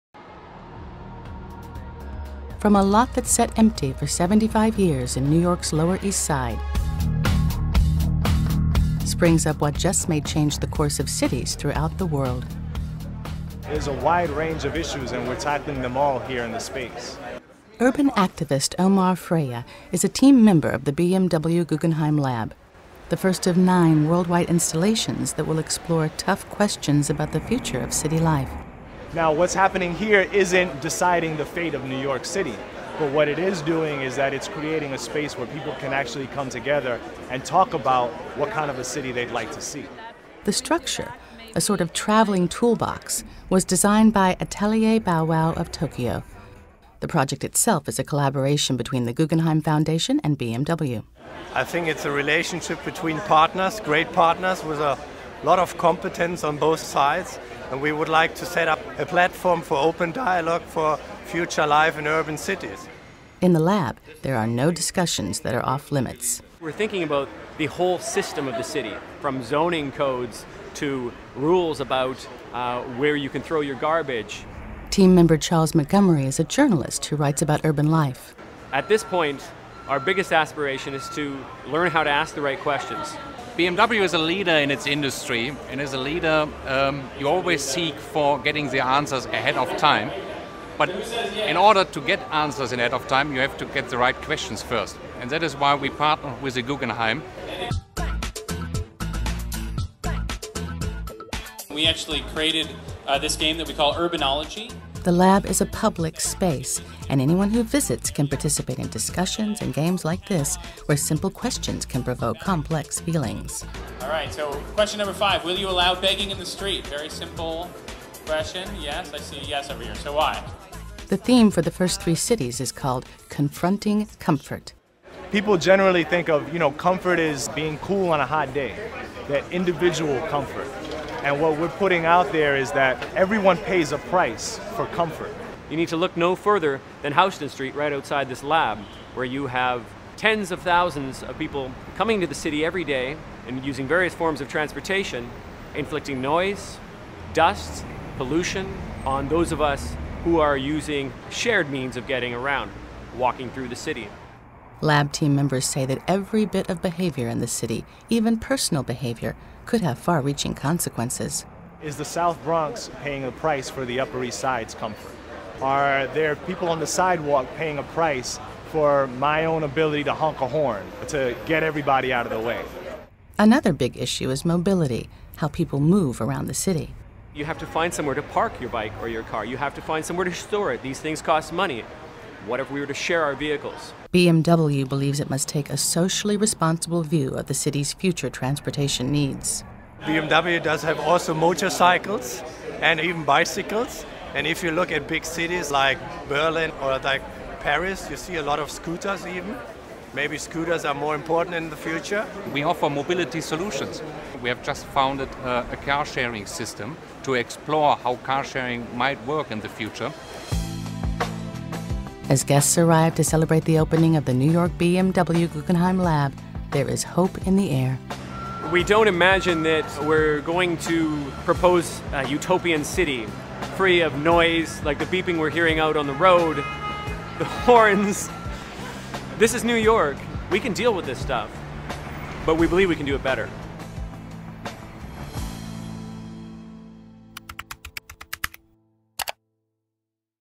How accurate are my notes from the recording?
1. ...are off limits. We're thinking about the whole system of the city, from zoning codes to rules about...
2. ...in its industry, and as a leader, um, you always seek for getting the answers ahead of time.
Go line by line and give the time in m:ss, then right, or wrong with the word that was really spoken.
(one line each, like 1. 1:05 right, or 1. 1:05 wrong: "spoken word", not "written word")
1. 1:05 right
2. 1:24 right.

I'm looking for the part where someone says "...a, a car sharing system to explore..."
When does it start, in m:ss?
3:25.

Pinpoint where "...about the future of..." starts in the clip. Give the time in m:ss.
0:27.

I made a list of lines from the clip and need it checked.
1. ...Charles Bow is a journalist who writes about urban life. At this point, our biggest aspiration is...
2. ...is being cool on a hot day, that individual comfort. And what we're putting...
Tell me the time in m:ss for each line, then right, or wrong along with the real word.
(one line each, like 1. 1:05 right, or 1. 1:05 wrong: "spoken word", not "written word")
1. 1:15 wrong: "Montgomery", not "Bow"
2. 2:07 right.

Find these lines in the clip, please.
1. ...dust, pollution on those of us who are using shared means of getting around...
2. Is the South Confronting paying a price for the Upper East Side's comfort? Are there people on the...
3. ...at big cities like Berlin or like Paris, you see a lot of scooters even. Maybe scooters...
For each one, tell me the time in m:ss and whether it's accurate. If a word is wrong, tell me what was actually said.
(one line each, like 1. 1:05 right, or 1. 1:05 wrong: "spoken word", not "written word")
1. 2:27 right
2. 2:41 wrong: "Bronx", not "Confronting"
3. 3:14 right.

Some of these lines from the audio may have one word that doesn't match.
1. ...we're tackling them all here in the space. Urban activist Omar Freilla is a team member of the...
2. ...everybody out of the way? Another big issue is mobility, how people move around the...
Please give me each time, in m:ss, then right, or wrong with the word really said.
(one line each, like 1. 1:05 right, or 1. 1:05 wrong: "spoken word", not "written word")
1. 0:15 right
2. 2:51 right.